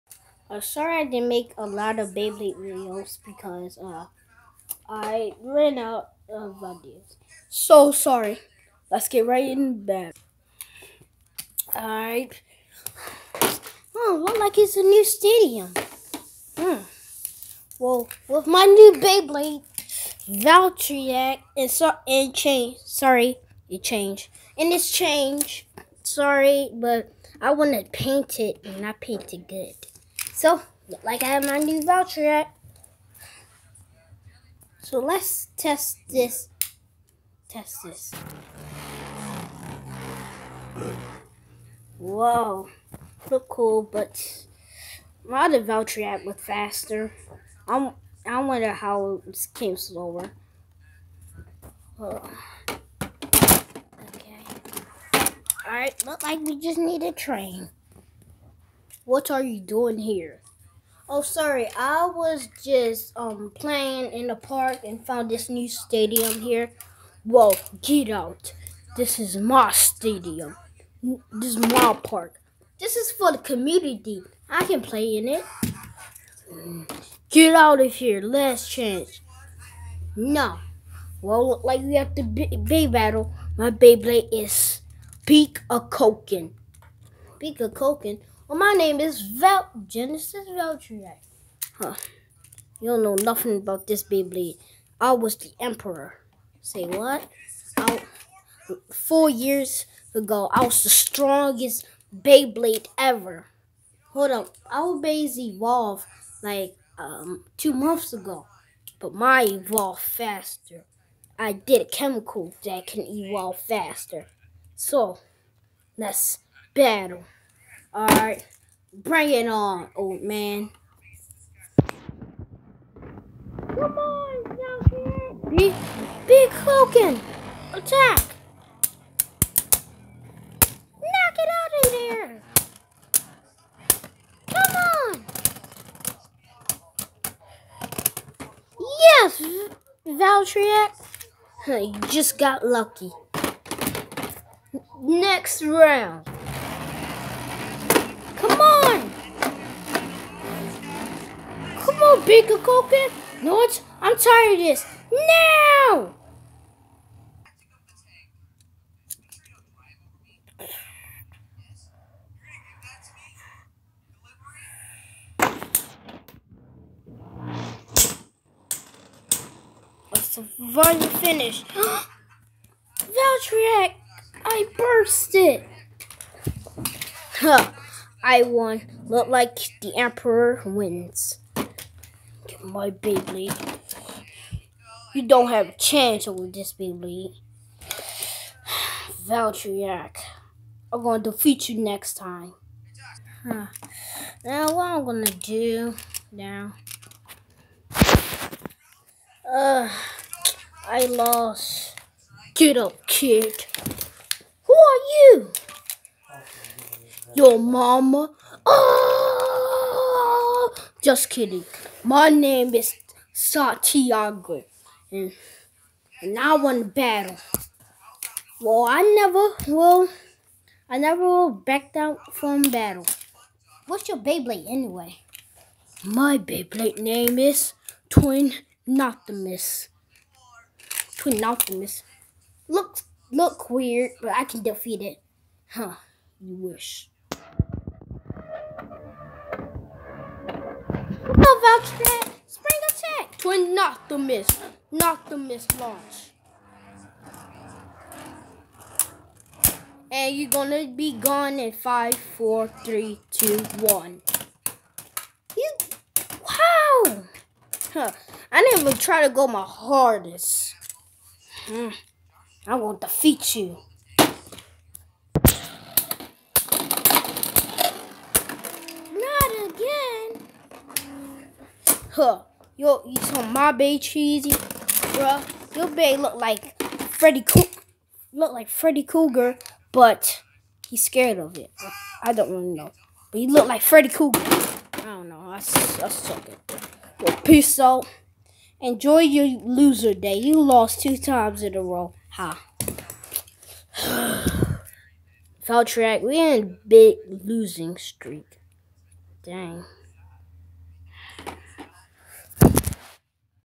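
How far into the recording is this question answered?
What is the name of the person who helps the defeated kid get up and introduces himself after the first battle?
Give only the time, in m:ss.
3:33.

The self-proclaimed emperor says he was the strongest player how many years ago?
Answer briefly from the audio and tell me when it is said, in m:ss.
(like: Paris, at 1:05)
4 years, at 1:38.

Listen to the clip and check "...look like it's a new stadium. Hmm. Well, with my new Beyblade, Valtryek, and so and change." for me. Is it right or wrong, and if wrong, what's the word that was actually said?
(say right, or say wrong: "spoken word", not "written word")
right.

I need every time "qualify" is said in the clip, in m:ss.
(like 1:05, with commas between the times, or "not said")
not said.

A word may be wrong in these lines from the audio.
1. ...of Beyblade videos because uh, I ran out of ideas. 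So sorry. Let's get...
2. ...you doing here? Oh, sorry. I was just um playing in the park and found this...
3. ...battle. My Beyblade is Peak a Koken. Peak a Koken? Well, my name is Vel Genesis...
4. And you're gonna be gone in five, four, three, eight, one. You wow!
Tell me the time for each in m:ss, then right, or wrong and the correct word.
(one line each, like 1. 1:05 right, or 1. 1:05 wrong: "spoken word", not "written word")
1. 0:01 right
2. 0:59 right
3. 1:22 right
4. 4:10 wrong: "two", not "eight".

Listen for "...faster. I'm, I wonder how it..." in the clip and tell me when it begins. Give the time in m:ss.
0:46.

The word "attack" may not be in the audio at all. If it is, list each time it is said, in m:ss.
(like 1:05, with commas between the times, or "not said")
2:07, 4:02.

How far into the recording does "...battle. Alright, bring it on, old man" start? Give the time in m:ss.
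1:56.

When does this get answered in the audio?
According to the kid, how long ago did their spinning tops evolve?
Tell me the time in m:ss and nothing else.
1:47.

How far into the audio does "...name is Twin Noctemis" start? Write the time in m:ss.
3:46.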